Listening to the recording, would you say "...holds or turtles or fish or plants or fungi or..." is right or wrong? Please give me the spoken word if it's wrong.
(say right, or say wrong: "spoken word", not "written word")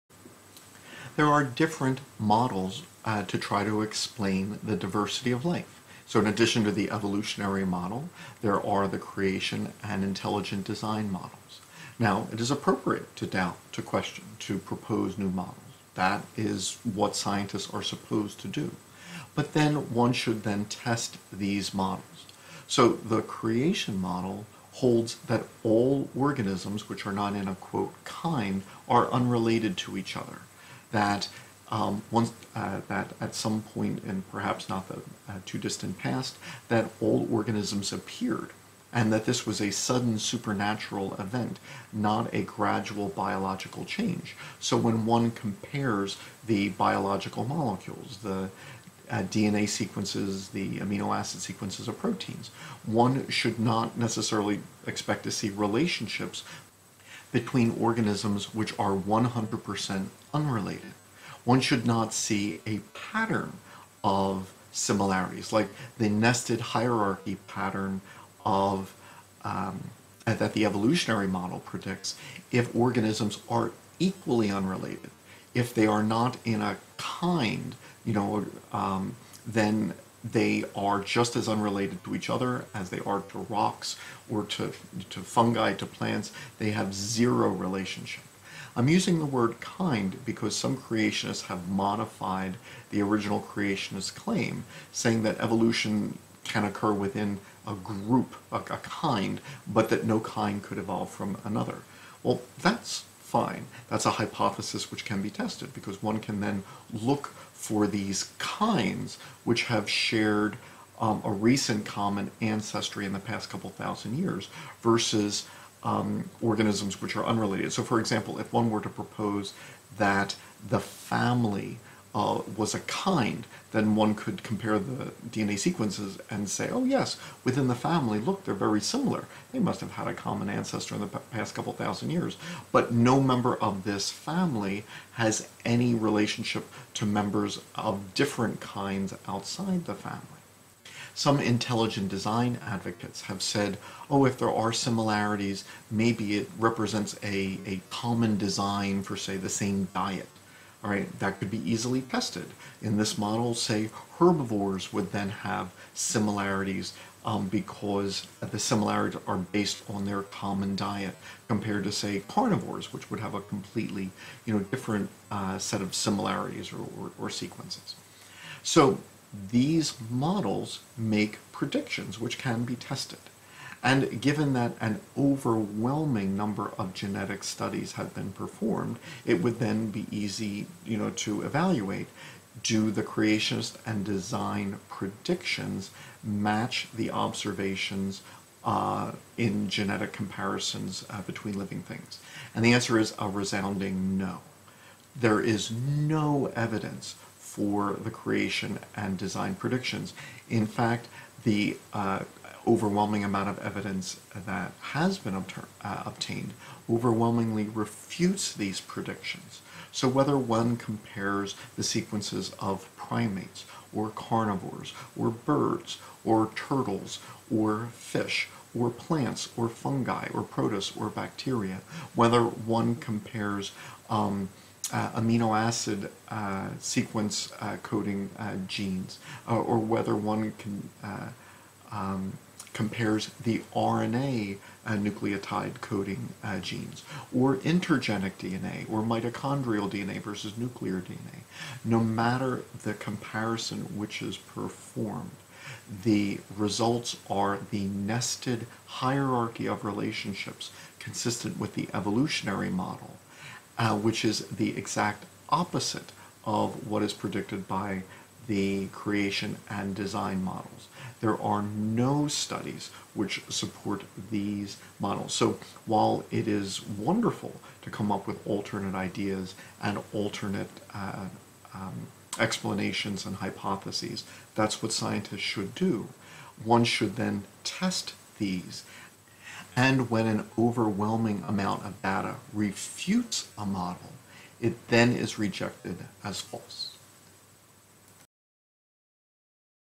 wrong: "birds", not "holds".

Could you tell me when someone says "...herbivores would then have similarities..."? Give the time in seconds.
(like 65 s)
154 s.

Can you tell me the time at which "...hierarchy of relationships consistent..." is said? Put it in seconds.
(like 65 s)
248 s.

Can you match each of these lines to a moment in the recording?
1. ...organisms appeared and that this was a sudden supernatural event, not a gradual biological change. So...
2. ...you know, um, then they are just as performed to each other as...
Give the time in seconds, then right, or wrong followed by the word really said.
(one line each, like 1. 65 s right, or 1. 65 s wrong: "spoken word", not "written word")
1. 37 s right
2. 78 s wrong: "unrelated", not "performed".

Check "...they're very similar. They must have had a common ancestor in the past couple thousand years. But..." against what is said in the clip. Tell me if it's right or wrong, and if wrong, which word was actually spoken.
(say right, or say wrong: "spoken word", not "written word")
right.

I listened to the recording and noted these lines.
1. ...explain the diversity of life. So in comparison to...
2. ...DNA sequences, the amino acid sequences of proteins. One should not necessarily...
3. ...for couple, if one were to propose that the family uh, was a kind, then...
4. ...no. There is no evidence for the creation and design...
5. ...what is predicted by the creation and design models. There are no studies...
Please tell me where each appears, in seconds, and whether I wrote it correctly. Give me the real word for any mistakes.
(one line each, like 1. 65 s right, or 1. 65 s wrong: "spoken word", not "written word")
1. 3 s wrong: "addition", not "comparison"
2. 49 s right
3. 117 s wrong: "example", not "couple"
4. 194 s right
5. 256 s right.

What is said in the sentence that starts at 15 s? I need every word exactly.
That is what scientists are supposed to do.